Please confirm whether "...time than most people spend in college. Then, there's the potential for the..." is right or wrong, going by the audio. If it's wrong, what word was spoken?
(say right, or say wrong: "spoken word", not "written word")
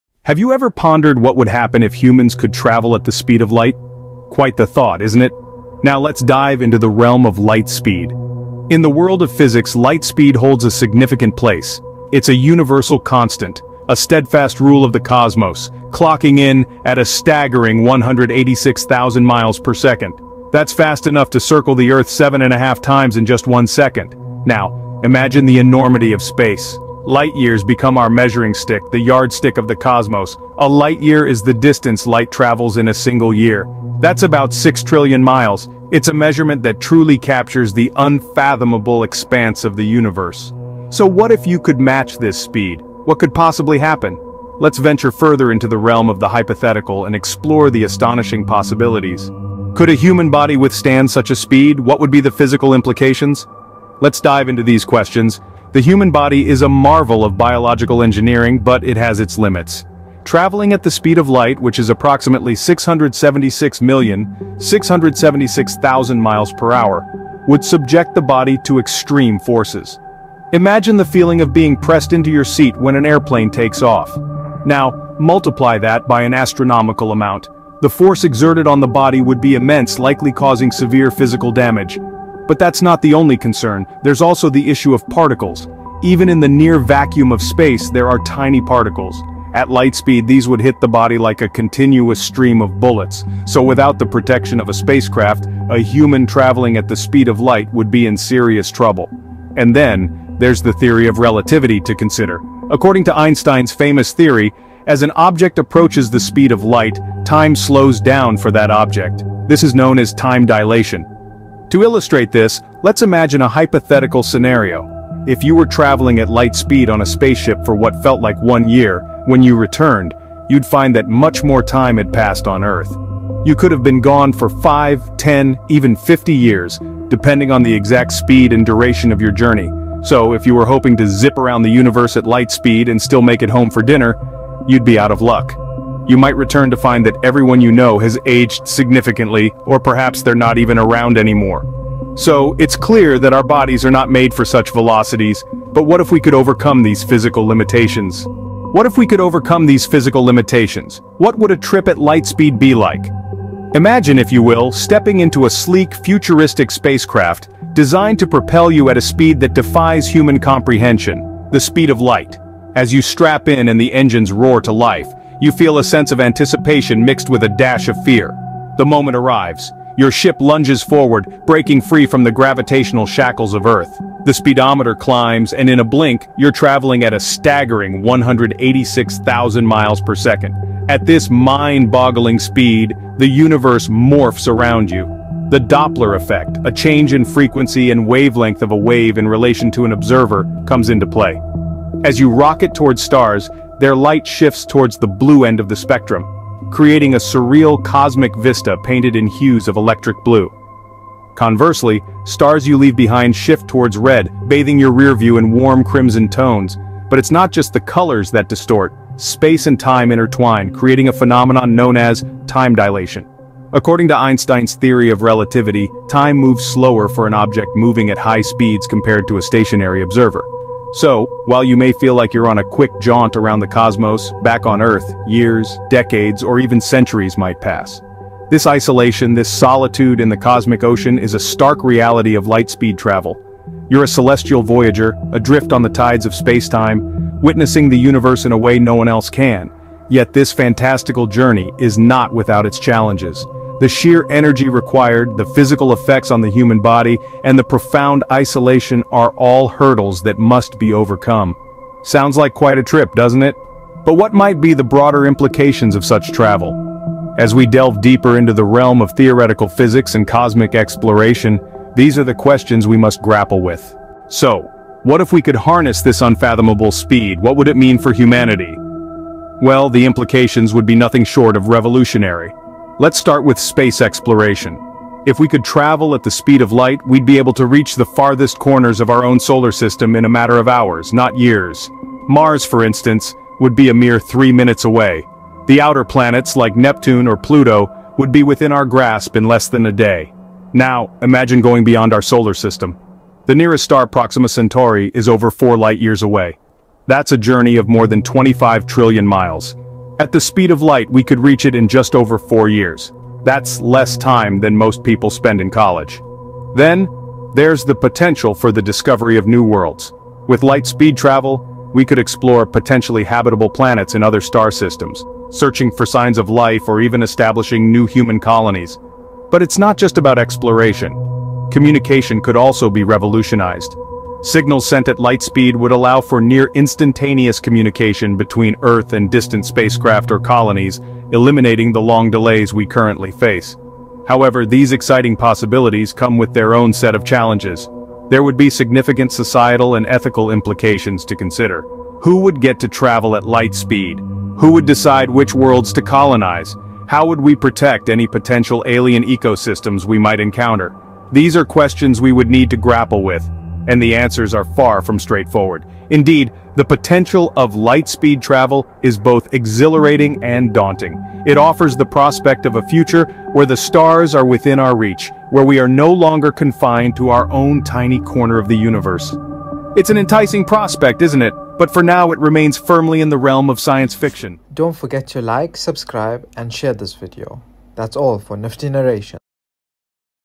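right.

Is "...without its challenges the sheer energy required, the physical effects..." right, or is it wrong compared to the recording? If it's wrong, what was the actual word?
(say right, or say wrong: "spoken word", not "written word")
right.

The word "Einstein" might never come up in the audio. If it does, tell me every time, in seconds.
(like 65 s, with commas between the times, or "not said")
103 s, 214 s.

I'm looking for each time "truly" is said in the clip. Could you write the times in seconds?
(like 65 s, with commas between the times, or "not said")
36 s.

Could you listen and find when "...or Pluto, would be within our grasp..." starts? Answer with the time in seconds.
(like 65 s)
287 s.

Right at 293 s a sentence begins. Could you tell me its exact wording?
The nearest star Proxima Centauri is over four light-years away.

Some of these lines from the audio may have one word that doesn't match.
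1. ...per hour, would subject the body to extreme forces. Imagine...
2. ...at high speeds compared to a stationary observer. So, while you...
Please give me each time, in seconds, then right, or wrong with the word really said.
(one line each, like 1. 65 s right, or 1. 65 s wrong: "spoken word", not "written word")
1. 66 s right
2. 218 s right.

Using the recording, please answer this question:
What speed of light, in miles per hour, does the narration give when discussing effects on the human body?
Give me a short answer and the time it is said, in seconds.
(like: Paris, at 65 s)
676,676,000, at 62 s.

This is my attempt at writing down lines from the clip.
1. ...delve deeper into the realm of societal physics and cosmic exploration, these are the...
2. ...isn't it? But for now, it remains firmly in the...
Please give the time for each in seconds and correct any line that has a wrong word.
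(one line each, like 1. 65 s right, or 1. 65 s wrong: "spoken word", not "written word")
1. 257 s wrong: "theoretical", not "societal"
2. 371 s right.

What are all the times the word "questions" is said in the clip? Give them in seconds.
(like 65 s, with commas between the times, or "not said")
54 s, 262 s, 351 s.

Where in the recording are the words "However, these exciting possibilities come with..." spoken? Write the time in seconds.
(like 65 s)
334 s.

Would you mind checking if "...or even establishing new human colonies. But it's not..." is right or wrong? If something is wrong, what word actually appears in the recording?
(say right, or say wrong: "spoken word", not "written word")
right.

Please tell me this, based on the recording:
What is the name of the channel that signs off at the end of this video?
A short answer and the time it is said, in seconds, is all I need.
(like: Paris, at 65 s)
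Nifty Narration, at 378 s.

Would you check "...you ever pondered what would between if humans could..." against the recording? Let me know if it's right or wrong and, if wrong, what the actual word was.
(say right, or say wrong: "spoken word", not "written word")
wrong: "happen", not "between".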